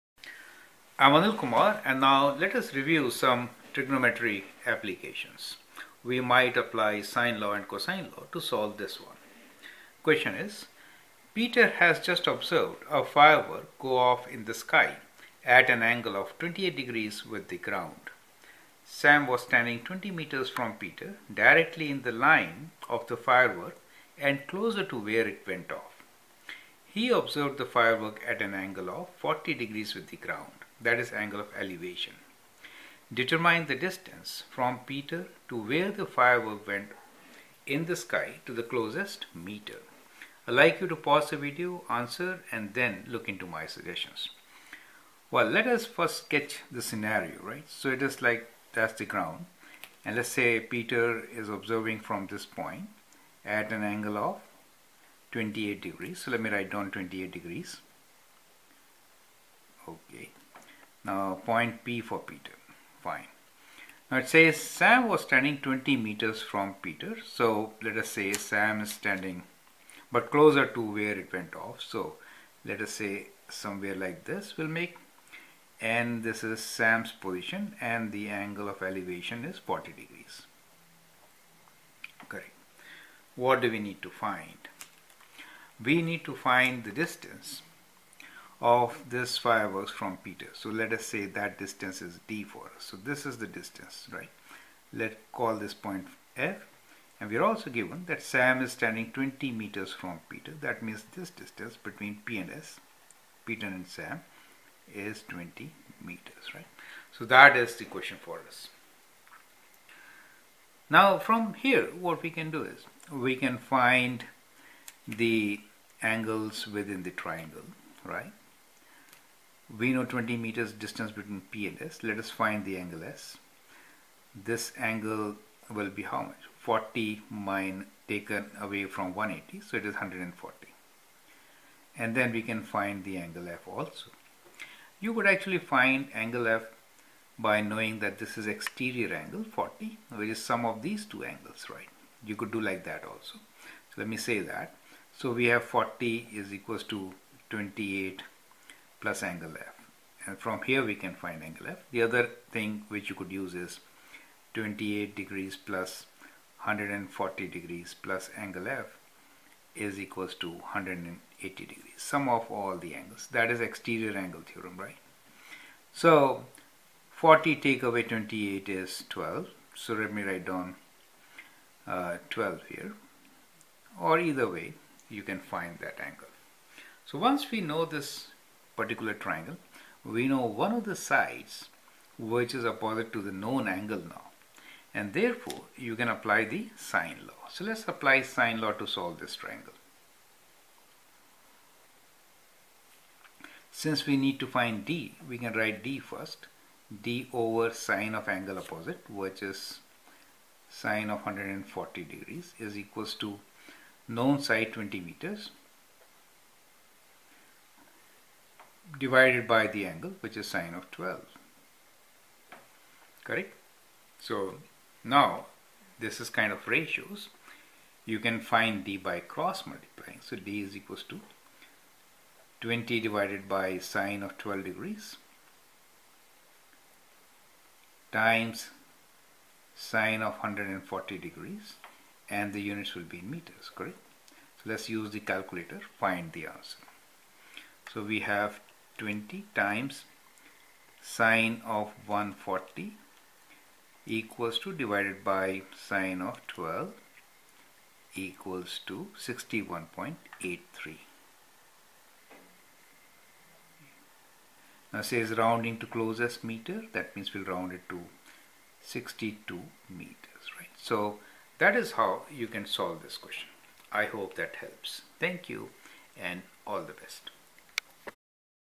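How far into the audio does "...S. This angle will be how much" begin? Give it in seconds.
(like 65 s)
123 s.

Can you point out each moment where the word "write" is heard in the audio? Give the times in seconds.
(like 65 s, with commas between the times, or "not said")
56 s, 170 s, 195 s.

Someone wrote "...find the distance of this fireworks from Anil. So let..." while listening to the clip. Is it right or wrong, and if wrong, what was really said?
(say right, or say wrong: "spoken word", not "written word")
wrong: "Peter", not "Anil".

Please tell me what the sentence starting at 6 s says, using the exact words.
We might apply sine law and cosine law to solve this one.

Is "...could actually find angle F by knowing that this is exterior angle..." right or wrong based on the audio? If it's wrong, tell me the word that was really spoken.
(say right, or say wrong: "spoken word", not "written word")
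right.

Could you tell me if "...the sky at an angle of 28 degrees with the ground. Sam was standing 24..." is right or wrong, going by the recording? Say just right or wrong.
wrong.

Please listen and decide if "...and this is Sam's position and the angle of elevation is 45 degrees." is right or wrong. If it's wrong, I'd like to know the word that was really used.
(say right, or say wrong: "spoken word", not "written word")
wrong: "40", not "45".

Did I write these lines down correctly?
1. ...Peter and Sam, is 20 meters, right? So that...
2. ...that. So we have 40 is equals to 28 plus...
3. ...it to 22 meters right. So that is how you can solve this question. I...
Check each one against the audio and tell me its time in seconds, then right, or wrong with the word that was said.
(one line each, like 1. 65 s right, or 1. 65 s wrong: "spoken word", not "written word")
1. 103 s right
2. 144 s right
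3. 257 s wrong: "62", not "22".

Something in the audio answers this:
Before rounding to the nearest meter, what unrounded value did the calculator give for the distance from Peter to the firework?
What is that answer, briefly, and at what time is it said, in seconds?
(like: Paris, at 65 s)
61.83, at 249 s.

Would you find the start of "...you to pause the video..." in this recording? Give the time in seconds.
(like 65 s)
40 s.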